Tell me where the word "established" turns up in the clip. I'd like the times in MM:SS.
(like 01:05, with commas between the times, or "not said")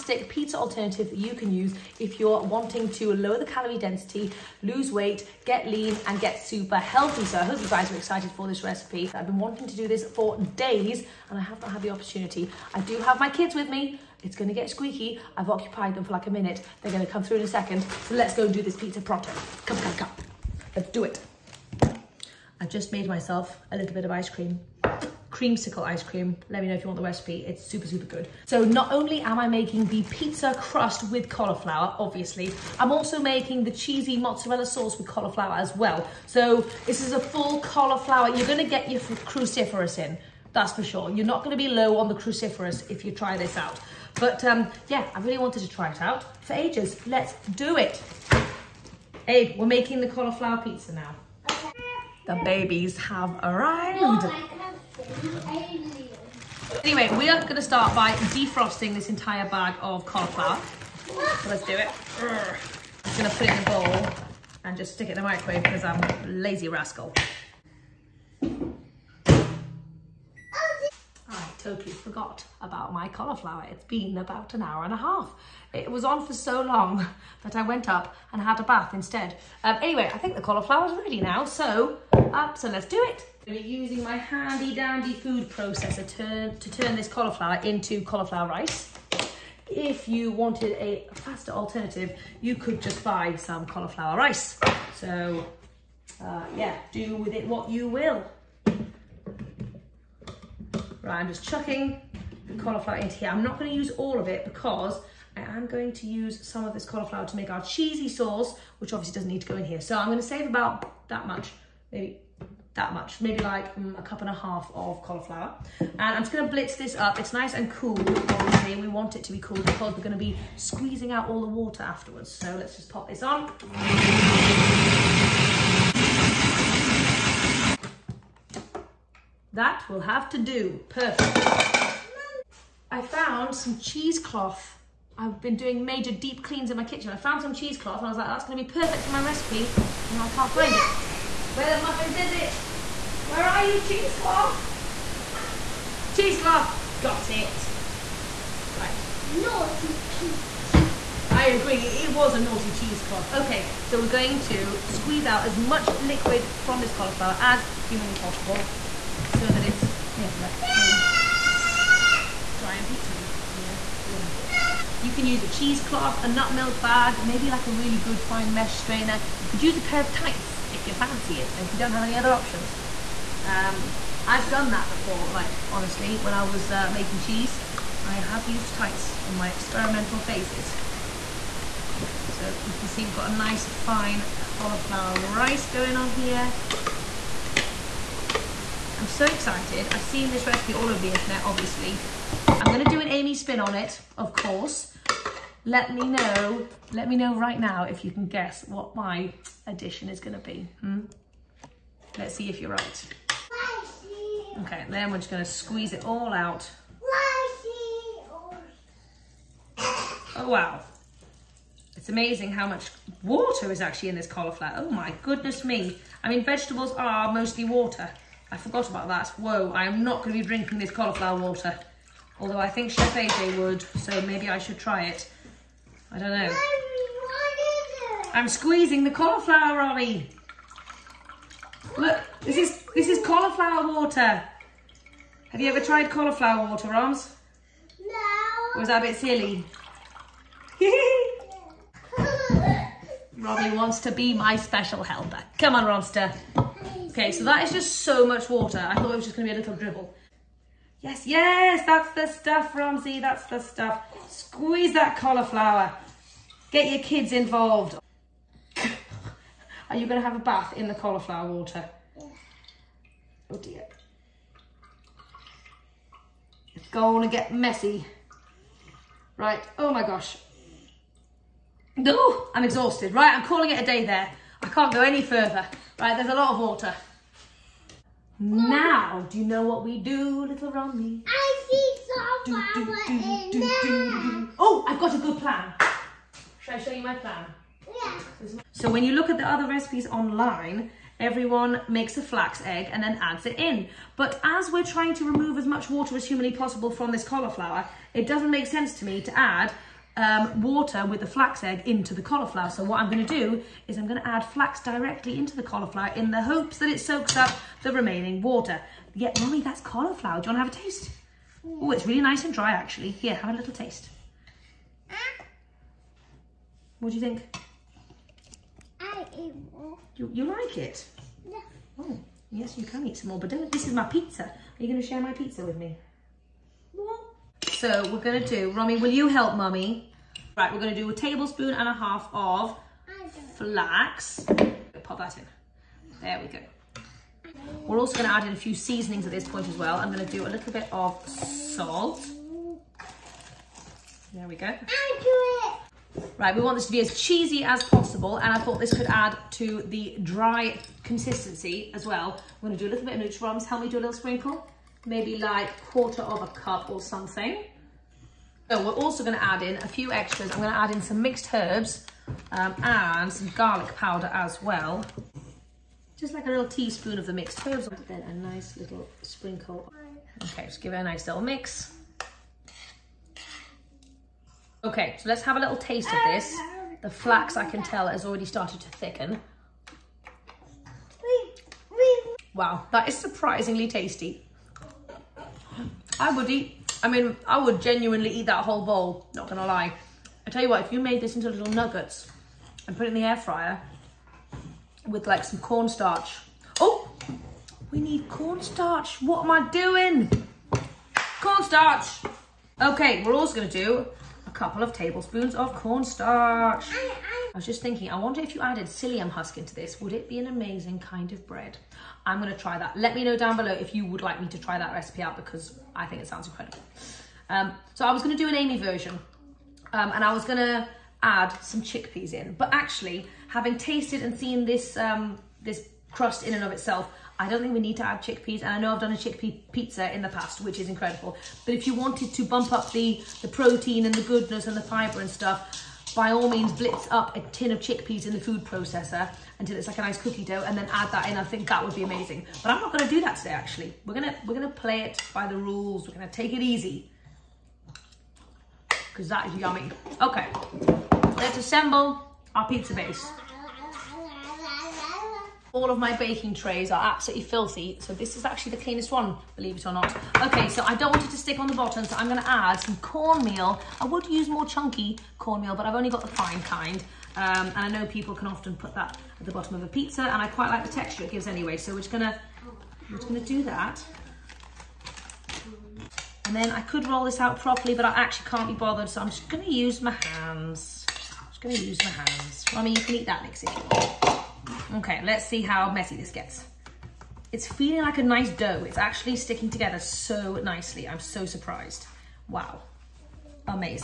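not said.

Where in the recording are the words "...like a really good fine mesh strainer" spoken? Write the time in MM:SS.
02:47.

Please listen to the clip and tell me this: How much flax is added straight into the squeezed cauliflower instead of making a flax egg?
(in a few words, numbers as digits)
A tablespoon and a half.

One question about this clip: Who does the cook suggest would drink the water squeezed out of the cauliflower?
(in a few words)
Chef AJ.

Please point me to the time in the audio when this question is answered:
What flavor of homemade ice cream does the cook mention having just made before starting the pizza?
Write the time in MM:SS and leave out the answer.
00:25.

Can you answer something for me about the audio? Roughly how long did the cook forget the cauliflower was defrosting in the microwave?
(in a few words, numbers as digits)
About an hour and a half.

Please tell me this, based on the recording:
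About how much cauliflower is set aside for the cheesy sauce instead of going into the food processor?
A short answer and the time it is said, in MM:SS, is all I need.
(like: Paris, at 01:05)
A cup and a half, at 01:53.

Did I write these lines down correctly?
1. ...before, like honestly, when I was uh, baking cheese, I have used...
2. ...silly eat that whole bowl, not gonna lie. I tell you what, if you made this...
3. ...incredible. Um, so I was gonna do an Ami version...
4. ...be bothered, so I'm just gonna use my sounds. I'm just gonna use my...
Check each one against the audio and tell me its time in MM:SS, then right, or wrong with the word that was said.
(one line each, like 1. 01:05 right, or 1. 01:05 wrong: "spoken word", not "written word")
1. 02:54 wrong: "making", not "baking"
2. 06:27 wrong: "genuinely", not "silly"
3. 06:56 right
4. 07:58 wrong: "hands", not "sounds".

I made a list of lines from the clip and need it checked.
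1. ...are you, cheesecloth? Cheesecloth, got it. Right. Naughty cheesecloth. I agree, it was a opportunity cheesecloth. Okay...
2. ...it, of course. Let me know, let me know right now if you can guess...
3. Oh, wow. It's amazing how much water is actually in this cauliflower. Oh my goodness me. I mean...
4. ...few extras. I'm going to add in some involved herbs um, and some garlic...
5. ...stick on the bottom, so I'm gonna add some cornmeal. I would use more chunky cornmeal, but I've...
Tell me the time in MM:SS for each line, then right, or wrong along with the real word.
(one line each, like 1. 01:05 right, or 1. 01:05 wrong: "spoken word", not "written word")
1. 02:23 wrong: "naughty", not "opportunity"
2. 03:13 right
3. 03:30 right
4. 05:59 wrong: "mixed", not "involved"
5. 07:41 right.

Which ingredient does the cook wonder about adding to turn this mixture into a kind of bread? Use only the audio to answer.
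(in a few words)
Psyllium husk.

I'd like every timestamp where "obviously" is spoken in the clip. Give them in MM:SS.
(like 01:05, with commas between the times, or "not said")
00:31, 01:48, 01:57, 03:11.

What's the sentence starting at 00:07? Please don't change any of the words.
So I hope you guys are excited for this recipe.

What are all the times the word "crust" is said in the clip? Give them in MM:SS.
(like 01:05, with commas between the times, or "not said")
00:30, 07:06.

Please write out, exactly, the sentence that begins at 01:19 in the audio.
Um, anyway, I think the cauliflower's ready now, so, up, uh, so let's do it.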